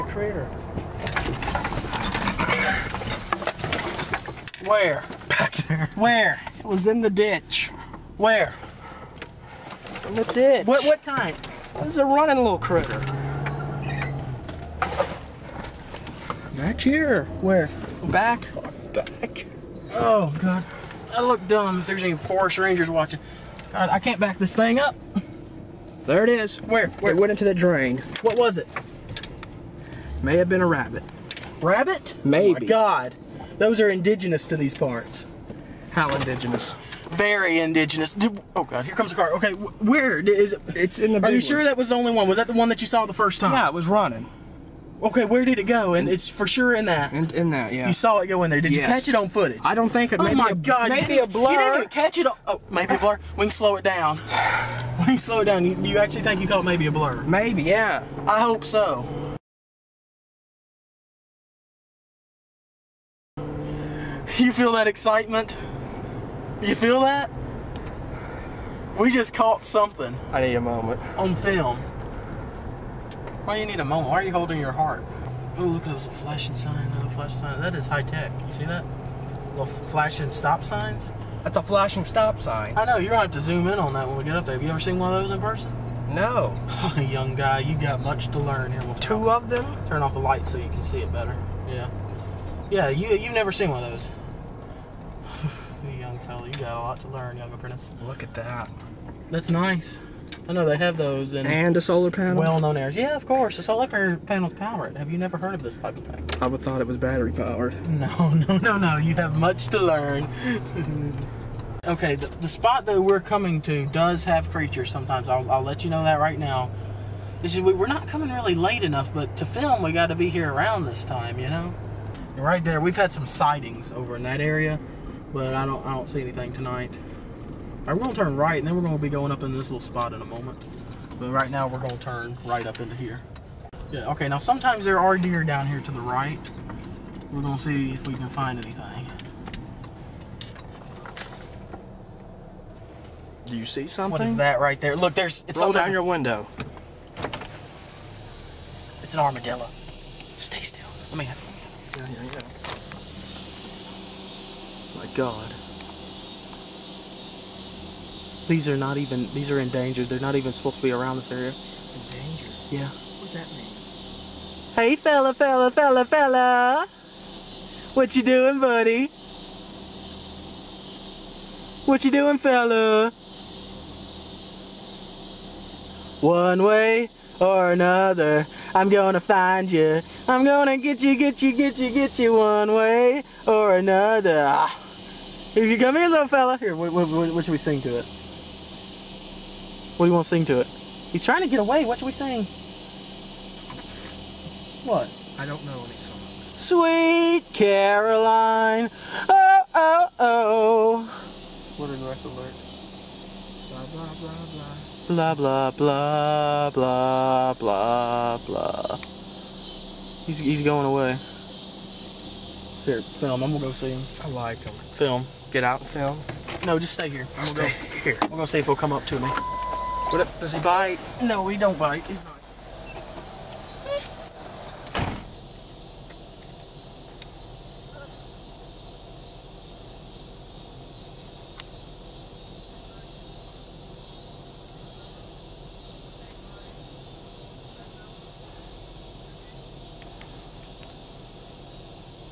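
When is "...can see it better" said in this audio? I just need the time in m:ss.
1:30.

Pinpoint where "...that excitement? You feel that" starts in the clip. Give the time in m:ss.
1:04.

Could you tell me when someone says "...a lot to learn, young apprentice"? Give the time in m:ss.
1:36.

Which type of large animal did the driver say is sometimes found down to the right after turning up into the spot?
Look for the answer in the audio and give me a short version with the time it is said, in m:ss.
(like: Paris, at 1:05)
Deer, at 2:14.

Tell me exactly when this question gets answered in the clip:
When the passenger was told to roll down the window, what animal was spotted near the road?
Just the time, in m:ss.
2:29.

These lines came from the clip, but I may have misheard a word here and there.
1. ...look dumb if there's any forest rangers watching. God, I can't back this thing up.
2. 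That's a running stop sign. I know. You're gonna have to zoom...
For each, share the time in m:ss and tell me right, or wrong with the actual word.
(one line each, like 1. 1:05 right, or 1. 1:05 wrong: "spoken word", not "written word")
1. 0:21 right
2. 1:21 wrong: "flashing", not "running".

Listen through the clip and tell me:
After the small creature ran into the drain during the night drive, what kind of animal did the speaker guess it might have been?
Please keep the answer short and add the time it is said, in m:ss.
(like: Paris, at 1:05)
Rabbit, at 0:30.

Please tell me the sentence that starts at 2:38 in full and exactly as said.
These are not even, these are endangered.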